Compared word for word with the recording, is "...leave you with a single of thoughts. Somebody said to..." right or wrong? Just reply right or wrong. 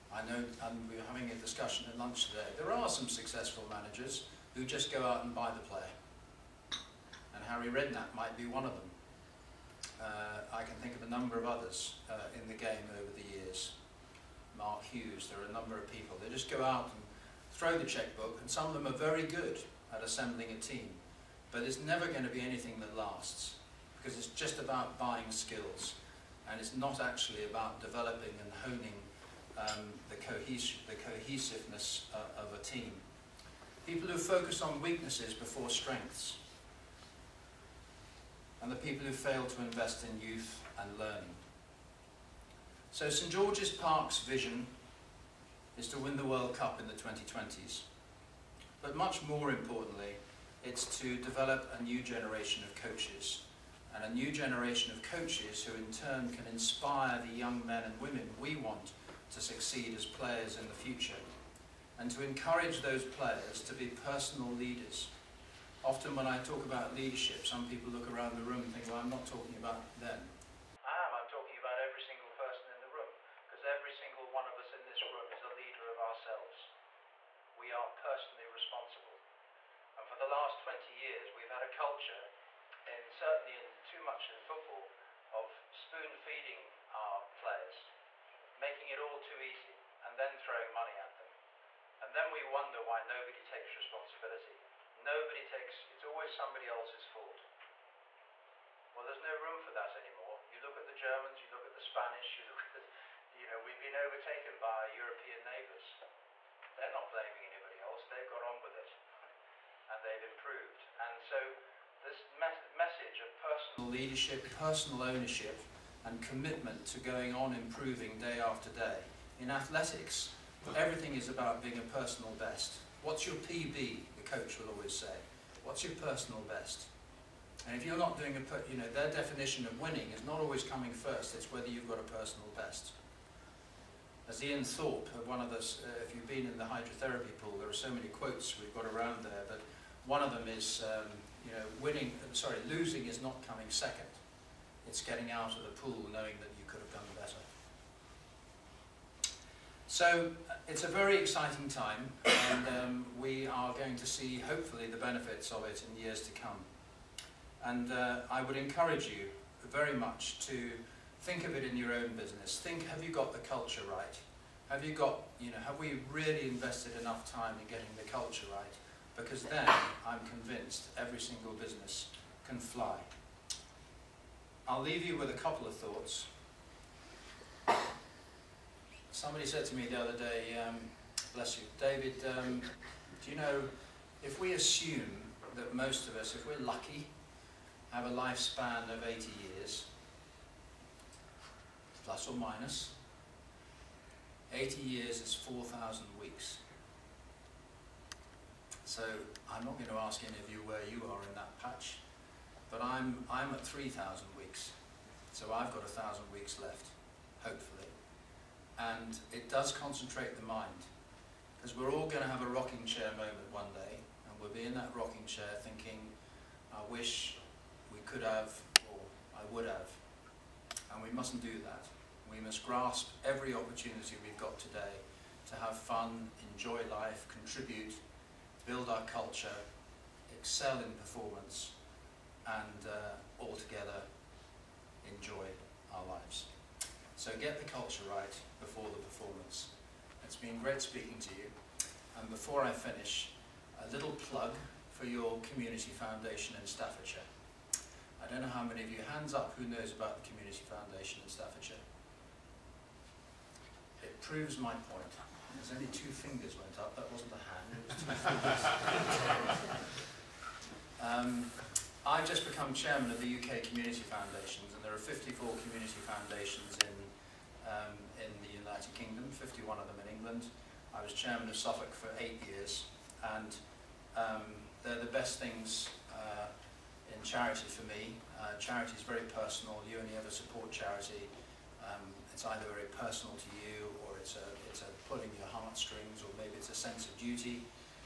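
wrong.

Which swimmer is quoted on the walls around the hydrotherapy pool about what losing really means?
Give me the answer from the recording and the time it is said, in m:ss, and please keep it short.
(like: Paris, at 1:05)
Ian Thorpe, at 2:14.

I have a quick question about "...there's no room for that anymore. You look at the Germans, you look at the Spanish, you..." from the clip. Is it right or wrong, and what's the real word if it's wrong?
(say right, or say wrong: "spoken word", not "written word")
right.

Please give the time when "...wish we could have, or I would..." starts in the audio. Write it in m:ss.
3:36.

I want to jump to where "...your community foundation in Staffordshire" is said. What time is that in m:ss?
4:05.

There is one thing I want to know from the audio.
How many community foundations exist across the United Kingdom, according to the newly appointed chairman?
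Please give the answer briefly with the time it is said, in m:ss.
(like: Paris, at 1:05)
54, at 4:25.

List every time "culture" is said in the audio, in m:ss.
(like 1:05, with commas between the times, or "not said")
1:21, 2:43, 2:48, 3:49, 3:57.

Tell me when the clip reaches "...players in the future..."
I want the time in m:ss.
1:00.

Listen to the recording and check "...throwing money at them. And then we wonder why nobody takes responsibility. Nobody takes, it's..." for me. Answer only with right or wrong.
right.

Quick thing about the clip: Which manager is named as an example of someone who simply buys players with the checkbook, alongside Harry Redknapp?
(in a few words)
Mark Hughes.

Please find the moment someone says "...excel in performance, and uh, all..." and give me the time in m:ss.
3:50.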